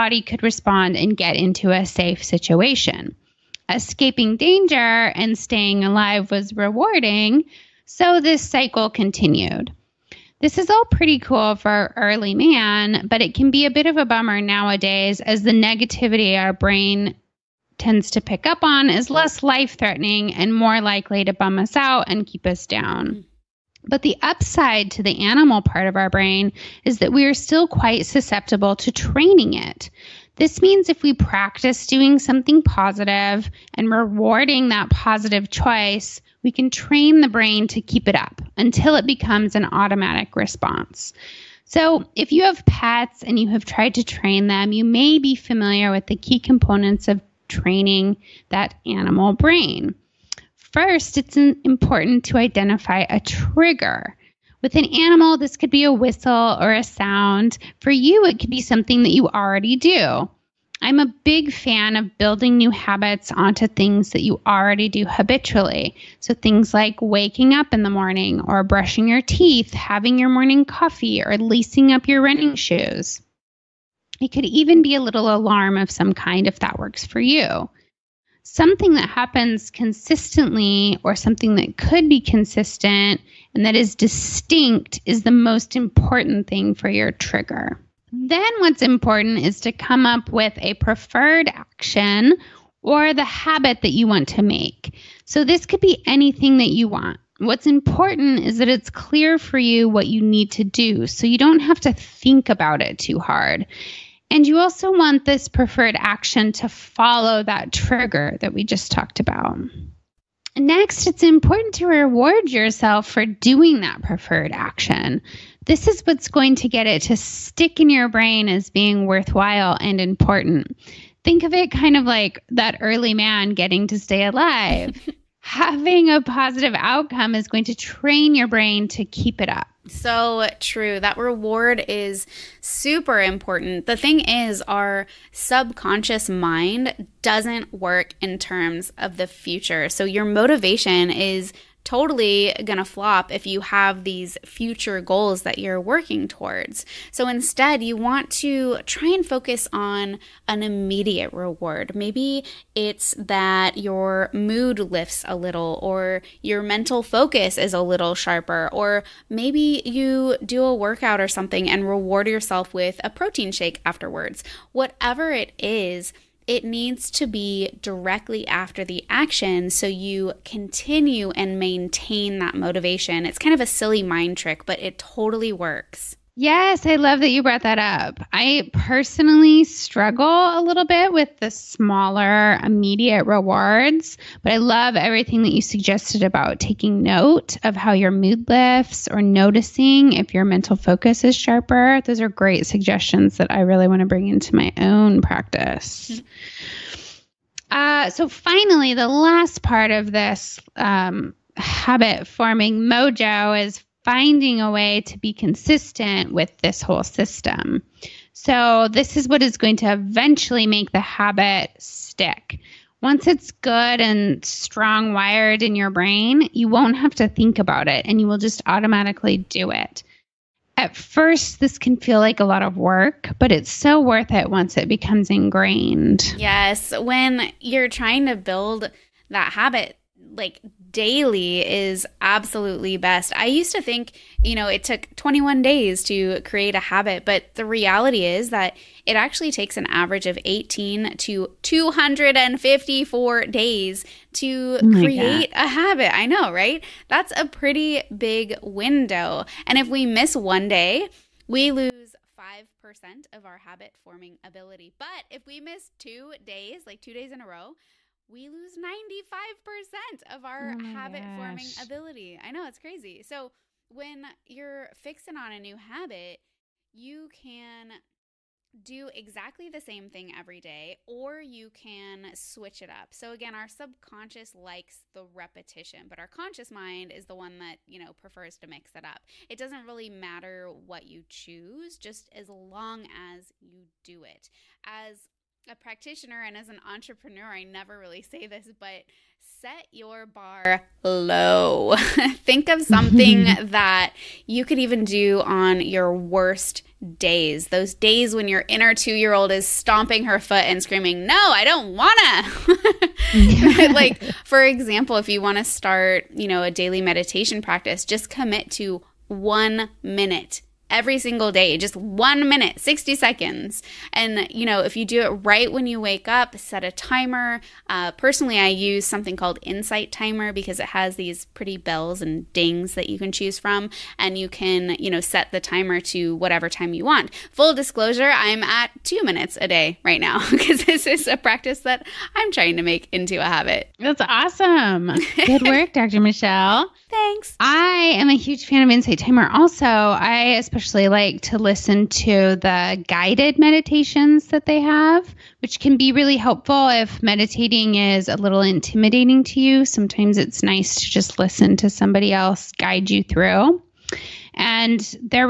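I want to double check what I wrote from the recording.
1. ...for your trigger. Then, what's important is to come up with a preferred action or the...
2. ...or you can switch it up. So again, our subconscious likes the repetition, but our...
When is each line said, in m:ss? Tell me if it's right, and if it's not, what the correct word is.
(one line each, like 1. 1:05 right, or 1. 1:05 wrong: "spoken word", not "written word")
1. 1:26 right
2. 4:31 right.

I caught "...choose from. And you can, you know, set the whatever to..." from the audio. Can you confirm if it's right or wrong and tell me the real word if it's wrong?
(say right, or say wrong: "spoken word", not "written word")
wrong: "timer", not "whatever".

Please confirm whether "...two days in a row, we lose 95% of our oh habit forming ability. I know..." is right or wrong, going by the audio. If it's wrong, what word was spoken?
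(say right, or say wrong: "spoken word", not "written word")
right.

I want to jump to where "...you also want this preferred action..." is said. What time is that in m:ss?
1:44.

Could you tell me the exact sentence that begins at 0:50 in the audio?
First, it's important to identify a trigger.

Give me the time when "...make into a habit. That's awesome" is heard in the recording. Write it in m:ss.
5:32.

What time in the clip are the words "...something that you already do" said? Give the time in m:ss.
0:58.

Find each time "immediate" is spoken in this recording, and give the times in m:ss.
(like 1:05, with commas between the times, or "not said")
2:30, 3:02.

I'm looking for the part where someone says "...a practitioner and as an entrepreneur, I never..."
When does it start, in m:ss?
4:45.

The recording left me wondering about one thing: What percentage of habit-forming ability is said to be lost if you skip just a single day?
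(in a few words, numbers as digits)
5%.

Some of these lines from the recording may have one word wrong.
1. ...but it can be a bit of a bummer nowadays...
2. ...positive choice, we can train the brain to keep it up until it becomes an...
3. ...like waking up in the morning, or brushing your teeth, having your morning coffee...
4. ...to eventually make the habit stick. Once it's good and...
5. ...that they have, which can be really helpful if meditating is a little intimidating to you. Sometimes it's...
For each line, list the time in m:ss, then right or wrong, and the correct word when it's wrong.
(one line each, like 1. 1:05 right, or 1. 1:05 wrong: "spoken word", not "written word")
1. 0:13 right
2. 0:34 right
3. 1:06 right
4. 3:29 right
5. 5:44 right.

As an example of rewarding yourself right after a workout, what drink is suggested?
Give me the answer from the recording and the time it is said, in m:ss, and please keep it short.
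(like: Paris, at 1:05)
protein shake, at 2:43.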